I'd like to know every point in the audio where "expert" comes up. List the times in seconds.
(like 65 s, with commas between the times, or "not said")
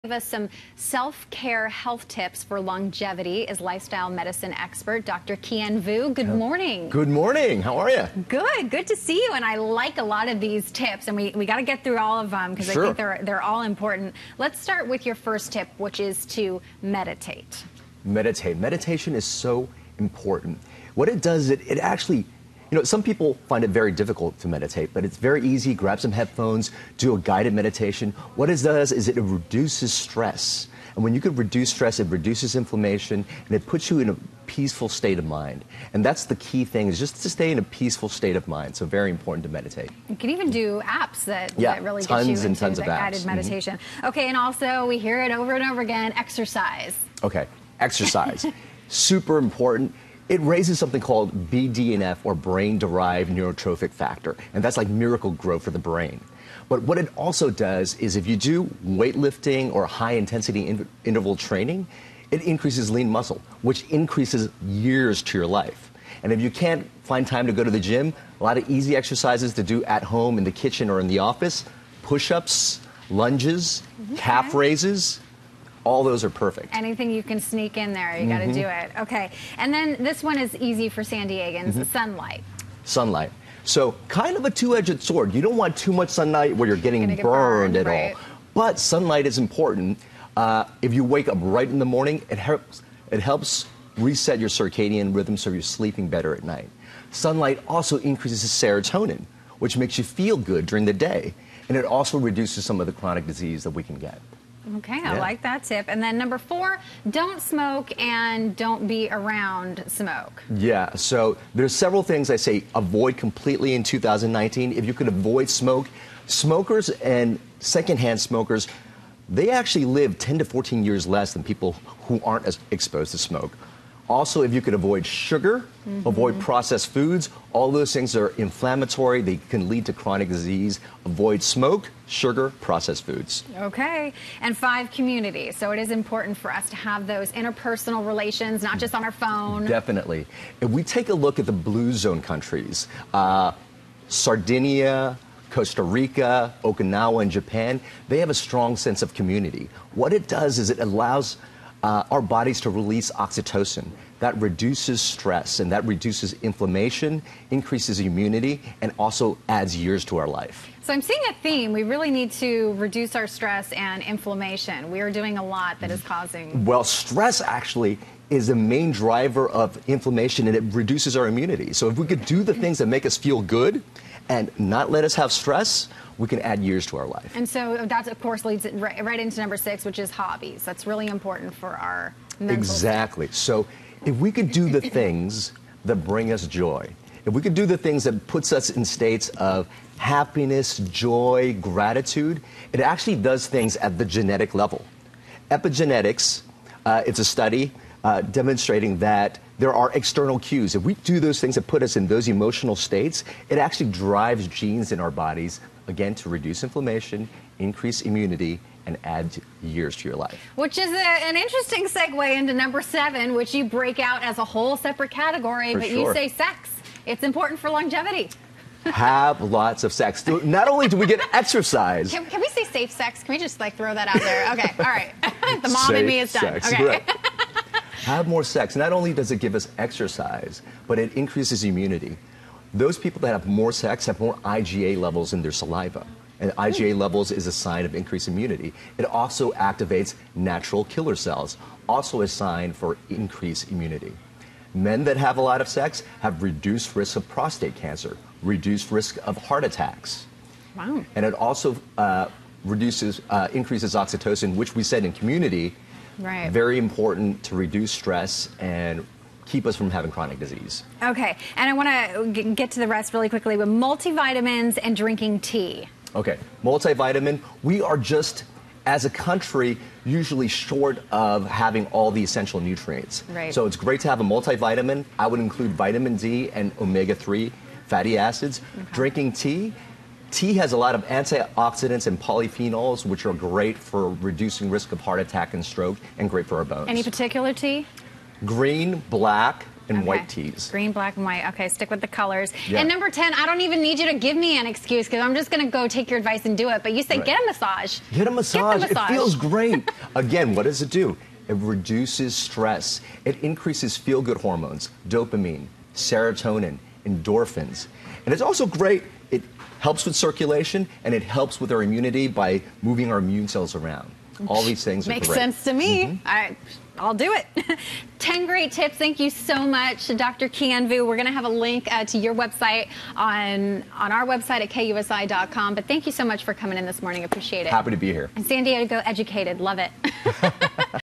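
4 s.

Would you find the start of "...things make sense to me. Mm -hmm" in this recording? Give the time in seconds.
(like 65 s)
314 s.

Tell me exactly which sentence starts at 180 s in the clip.
That's really important for our mental Exactly.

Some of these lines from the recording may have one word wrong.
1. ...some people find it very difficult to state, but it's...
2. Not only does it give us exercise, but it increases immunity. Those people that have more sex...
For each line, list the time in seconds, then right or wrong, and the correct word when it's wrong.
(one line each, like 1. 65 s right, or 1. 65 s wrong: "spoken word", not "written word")
1. 22 s wrong: "meditate", not "state"
2. 228 s right.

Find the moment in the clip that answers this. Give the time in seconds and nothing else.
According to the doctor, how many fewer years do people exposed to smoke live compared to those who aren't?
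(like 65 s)
120 s.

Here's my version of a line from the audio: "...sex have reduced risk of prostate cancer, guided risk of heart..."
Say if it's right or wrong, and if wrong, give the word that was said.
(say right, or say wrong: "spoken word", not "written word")
wrong: "reduced", not "guided".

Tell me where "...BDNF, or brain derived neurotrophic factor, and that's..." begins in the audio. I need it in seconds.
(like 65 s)
51 s.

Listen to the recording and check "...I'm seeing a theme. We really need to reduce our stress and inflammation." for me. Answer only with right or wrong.
right.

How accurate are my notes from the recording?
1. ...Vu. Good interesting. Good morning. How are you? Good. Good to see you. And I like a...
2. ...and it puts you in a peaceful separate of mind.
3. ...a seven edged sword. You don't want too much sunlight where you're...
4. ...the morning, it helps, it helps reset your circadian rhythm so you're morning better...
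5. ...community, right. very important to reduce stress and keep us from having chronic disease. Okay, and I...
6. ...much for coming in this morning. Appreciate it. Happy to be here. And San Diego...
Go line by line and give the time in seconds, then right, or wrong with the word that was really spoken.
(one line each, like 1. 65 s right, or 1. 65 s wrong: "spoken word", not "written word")
1. 5 s wrong: "morning", not "interesting"
2. 33 s wrong: "state", not "separate"
3. 84 s wrong: "two", not "seven"
4. 91 s wrong: "sleeping", not "morning"
5. 255 s right
6. 326 s right.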